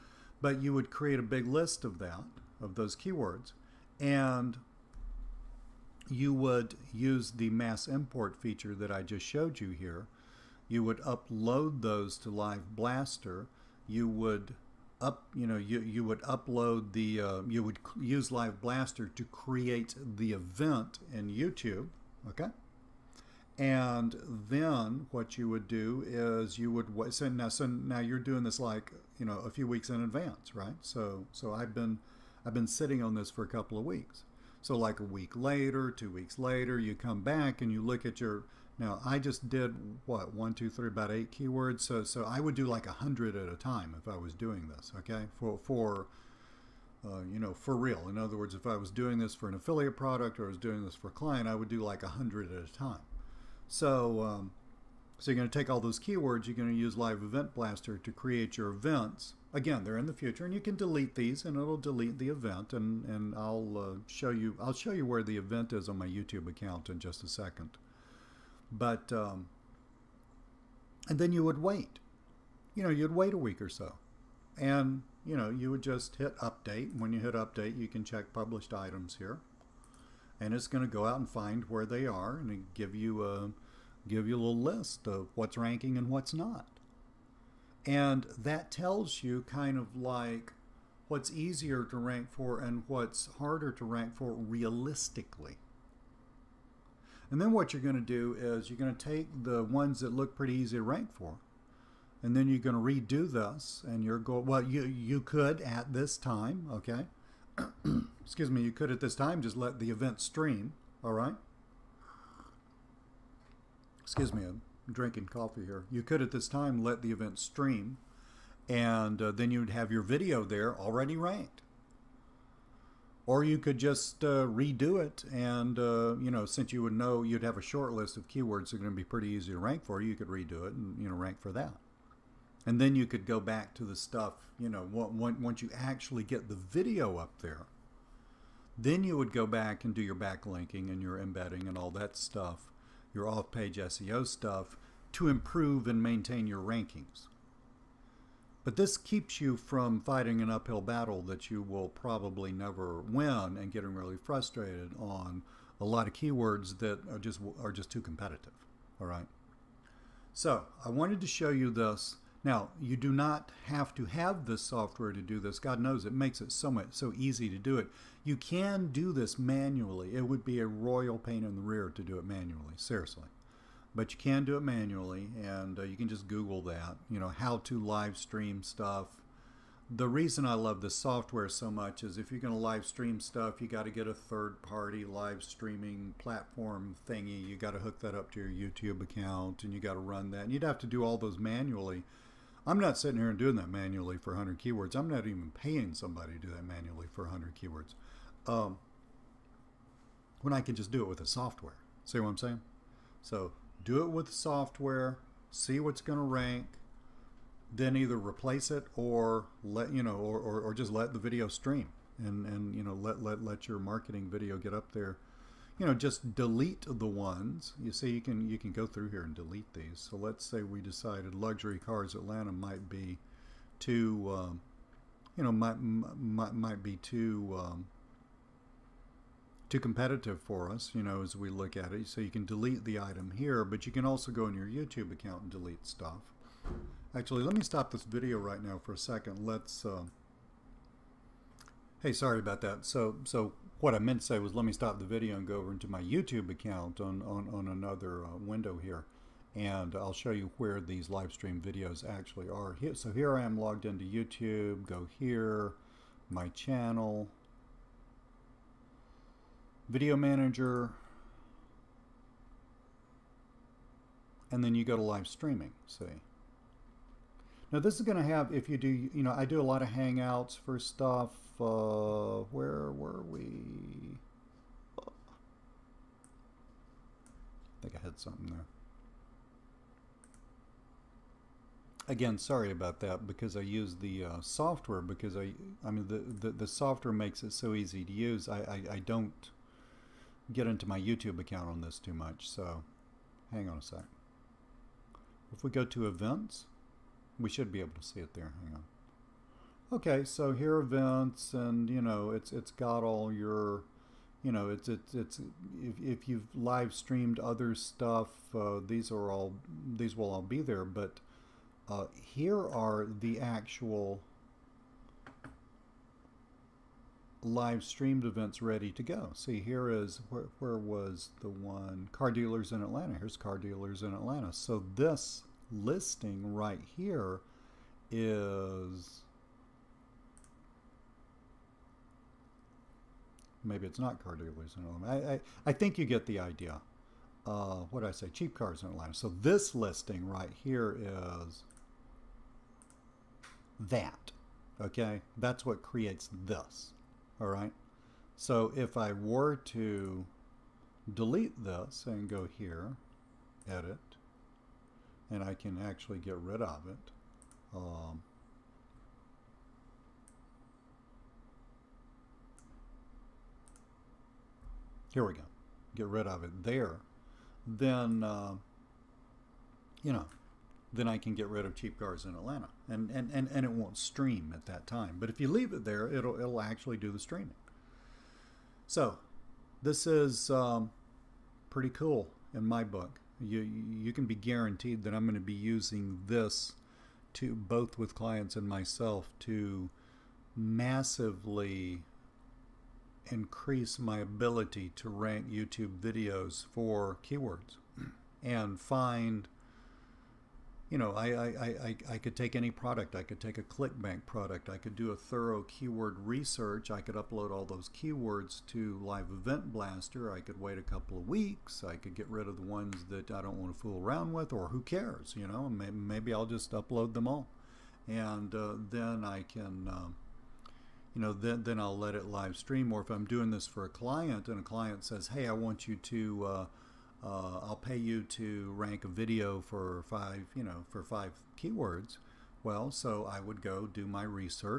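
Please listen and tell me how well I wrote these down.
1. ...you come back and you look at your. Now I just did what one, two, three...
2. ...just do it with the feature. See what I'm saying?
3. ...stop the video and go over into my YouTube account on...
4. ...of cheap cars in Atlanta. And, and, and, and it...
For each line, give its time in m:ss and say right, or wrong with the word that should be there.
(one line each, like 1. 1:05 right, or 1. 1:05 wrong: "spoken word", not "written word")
1. 0:36 right
2. 3:20 wrong: "software", not "feature"
3. 4:04 right
4. 6:11 right.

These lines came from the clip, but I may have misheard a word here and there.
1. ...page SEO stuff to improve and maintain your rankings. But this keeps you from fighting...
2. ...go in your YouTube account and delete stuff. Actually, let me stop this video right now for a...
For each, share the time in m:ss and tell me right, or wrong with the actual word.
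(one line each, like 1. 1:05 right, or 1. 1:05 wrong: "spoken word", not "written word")
1. 2:23 right
2. 3:54 right.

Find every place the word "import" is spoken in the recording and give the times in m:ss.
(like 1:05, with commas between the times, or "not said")
0:07.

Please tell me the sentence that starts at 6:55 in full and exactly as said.
Maybe I'll just upload them all.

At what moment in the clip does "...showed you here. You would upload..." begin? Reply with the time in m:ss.
0:09.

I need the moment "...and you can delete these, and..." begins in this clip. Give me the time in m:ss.
1:00.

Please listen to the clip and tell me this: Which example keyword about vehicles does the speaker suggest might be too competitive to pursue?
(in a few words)
luxury cars Atlanta.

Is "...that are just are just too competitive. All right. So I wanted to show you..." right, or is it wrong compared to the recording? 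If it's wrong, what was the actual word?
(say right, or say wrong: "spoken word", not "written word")
right.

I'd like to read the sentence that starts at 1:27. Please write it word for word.
And that tells you kind of like what's easier to rank for and what's harder to rank for realistically.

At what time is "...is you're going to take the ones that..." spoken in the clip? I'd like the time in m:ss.
1:38.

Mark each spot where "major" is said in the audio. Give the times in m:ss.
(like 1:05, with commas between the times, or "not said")
not said.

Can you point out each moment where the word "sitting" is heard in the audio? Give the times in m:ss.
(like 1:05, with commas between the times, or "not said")
0:32, 3:12.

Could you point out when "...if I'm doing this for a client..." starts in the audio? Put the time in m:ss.
7:03.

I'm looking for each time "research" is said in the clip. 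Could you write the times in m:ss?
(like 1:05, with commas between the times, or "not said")
6:46, 7:14.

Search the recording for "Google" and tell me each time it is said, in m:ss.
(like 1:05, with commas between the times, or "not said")
2:56.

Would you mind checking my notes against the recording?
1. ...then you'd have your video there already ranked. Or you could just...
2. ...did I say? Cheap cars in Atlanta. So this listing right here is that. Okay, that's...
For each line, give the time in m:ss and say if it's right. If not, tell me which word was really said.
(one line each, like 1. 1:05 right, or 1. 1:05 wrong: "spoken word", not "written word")
1. 1:59 right
2. 5:38 right.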